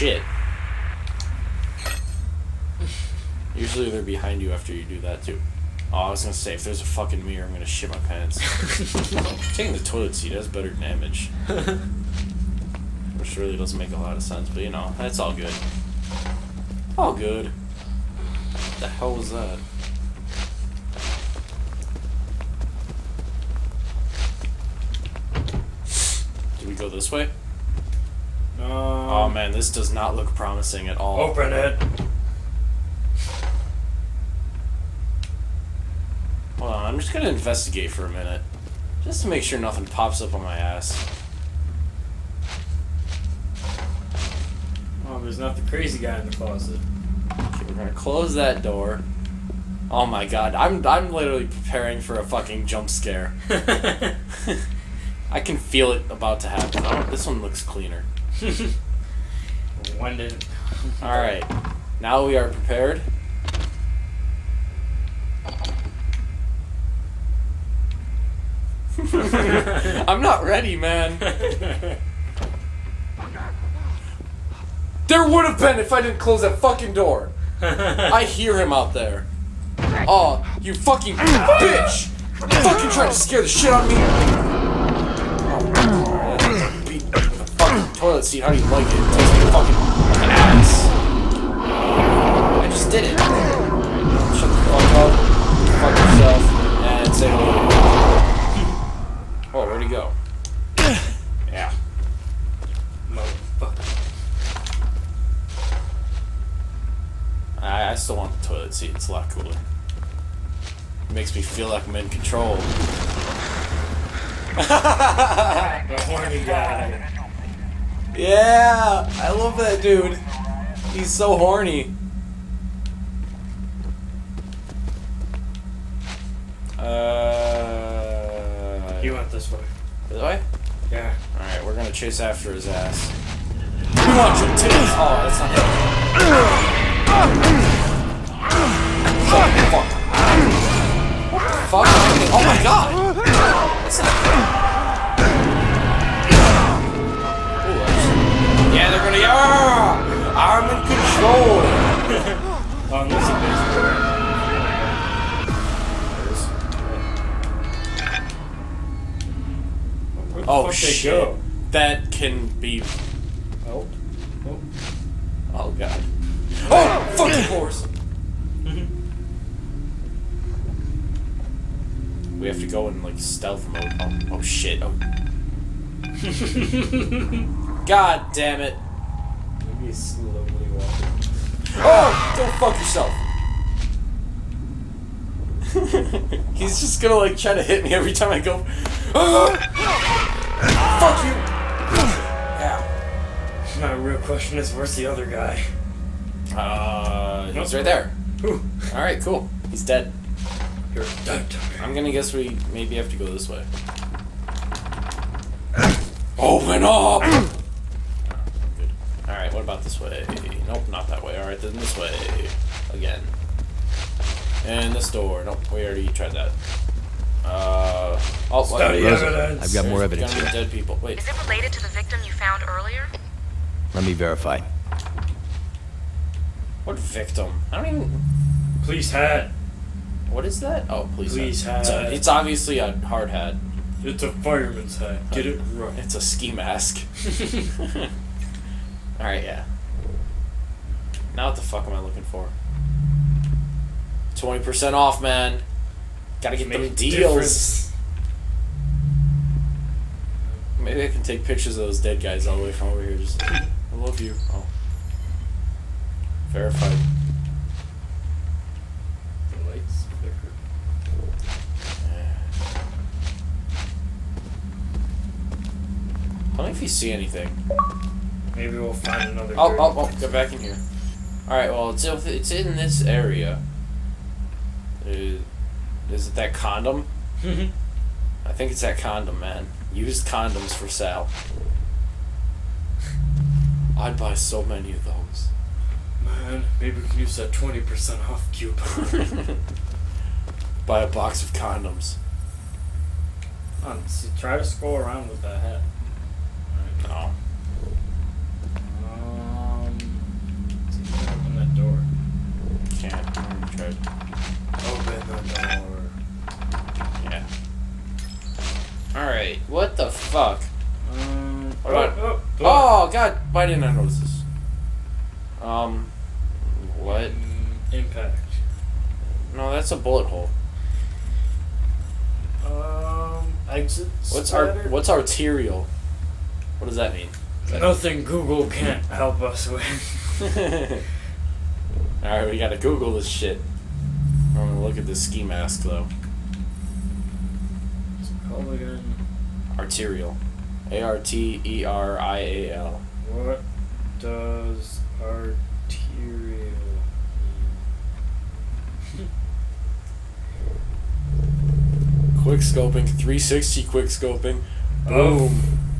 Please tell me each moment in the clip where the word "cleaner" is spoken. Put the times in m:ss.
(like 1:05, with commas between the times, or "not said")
0:57.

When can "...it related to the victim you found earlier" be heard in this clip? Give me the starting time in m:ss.
3:41.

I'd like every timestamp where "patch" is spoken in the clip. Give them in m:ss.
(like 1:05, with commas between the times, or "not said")
not said.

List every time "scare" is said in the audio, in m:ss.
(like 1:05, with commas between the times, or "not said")
0:52, 1:23.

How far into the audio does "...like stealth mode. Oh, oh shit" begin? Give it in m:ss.
2:53.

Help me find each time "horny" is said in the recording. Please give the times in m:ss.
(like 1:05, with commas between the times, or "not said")
1:56, 2:01.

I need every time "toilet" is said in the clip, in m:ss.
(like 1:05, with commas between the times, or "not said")
0:09, 1:48.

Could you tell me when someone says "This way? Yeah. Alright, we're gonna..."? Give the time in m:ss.
2:10.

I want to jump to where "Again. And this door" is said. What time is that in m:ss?
3:32.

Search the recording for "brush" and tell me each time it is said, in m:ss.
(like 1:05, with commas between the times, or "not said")
not said.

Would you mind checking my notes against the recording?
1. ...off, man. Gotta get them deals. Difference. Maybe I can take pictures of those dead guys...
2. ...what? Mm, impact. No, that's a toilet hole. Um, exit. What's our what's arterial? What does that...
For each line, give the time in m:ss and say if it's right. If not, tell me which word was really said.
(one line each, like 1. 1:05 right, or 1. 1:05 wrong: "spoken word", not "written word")
1. 4:04 right
2. 5:16 wrong: "bullet", not "toilet".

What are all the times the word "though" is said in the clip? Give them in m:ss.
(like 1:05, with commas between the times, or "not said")
5:35.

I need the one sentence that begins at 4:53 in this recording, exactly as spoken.
On, see, try to scroll around with that hat.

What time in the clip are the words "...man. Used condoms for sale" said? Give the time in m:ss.
4:39.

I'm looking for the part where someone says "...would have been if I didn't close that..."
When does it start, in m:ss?
1:15.